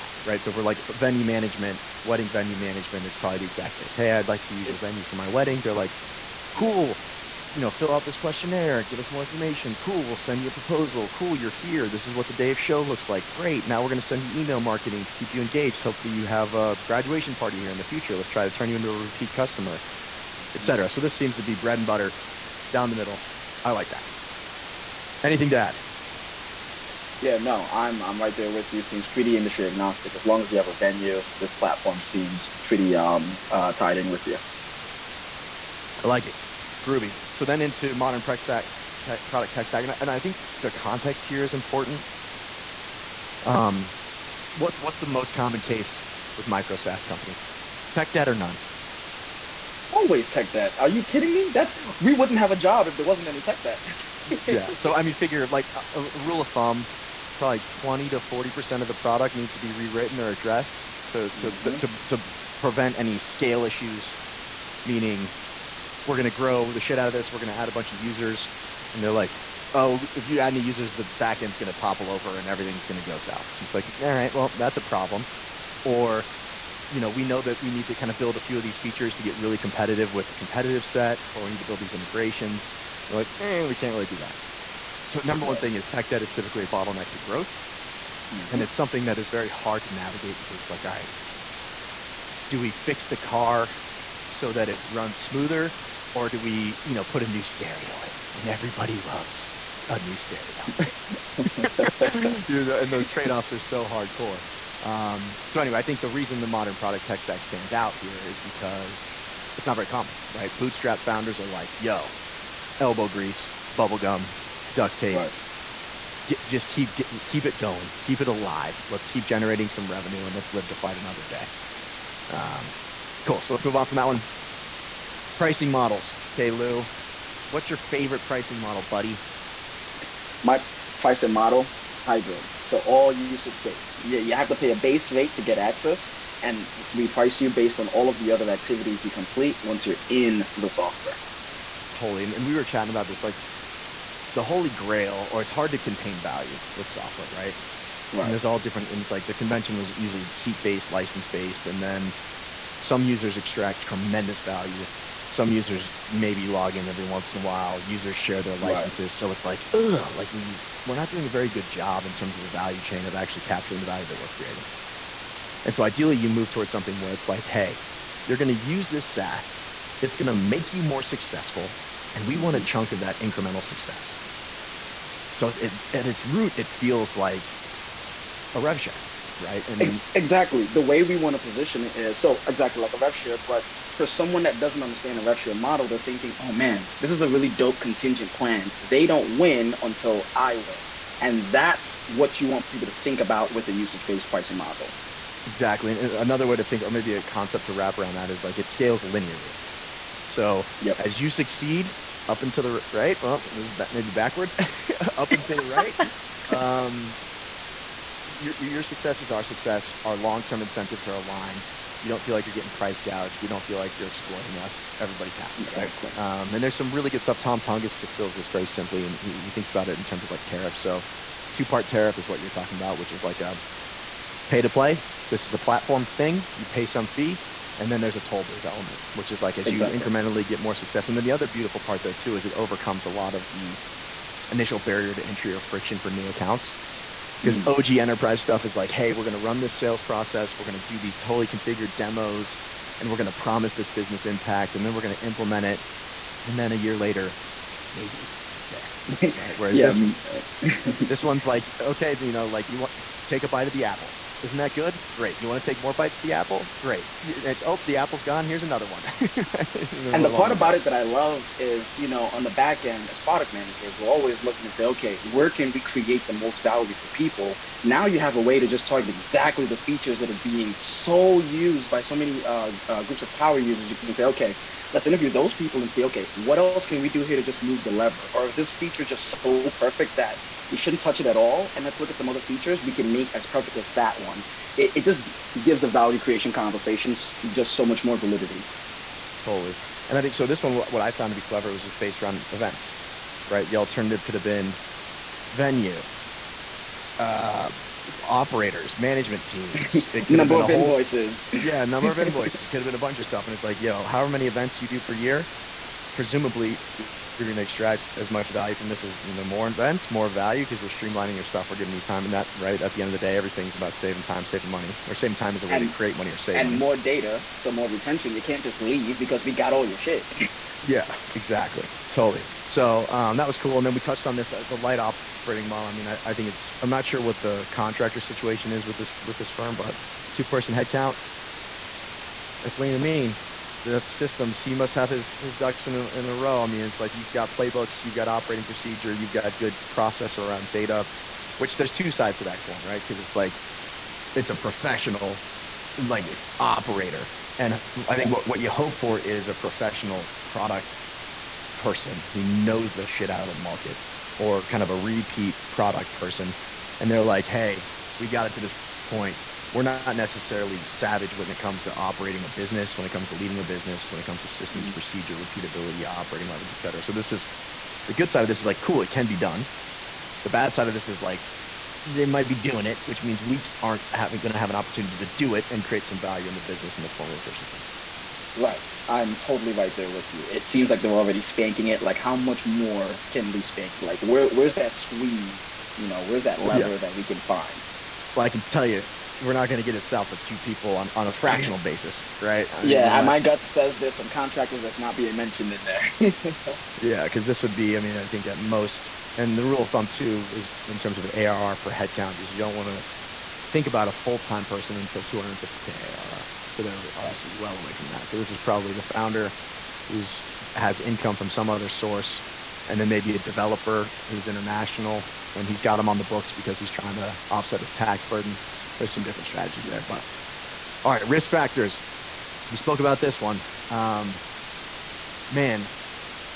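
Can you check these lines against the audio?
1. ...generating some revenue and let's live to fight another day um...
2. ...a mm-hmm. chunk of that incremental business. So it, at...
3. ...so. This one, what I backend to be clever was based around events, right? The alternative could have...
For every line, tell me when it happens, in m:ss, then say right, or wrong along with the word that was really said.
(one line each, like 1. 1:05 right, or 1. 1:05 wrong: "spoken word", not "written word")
1. 1:59 right
2. 2:52 wrong: "success", not "business"
3. 4:50 wrong: "found", not "backend".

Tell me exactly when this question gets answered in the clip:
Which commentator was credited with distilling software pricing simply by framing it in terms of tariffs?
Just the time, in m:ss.
3:37.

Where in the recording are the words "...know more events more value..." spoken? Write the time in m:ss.
5:09.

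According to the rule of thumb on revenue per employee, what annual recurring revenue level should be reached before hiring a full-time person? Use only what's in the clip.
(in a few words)
$250k ARR.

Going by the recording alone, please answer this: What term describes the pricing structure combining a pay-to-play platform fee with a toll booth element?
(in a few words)
Two-part tariff.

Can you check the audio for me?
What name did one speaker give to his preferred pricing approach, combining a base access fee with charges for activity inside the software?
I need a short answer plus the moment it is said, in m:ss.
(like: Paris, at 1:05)
Hybrid, at 2:12.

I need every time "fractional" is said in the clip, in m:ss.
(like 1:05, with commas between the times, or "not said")
6:31.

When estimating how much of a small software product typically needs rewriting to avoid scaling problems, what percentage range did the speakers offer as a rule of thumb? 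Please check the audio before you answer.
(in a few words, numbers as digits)
20 to 40 percent.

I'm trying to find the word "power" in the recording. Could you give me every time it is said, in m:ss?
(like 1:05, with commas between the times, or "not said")
4:33.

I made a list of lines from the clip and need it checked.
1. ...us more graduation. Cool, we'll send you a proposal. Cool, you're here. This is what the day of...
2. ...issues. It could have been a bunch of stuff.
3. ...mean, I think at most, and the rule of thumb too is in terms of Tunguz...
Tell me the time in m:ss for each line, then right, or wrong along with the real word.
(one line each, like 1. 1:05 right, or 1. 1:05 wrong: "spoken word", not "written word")
1. 0:08 wrong: "information", not "graduation"
2. 5:02 wrong: "invoices", not "issues"
3. 6:37 wrong: "ARR", not "Tunguz".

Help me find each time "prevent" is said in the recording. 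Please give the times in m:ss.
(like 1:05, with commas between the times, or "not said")
1:02.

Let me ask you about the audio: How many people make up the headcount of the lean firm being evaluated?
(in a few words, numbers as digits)
2.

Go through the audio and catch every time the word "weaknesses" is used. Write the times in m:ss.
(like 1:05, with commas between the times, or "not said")
not said.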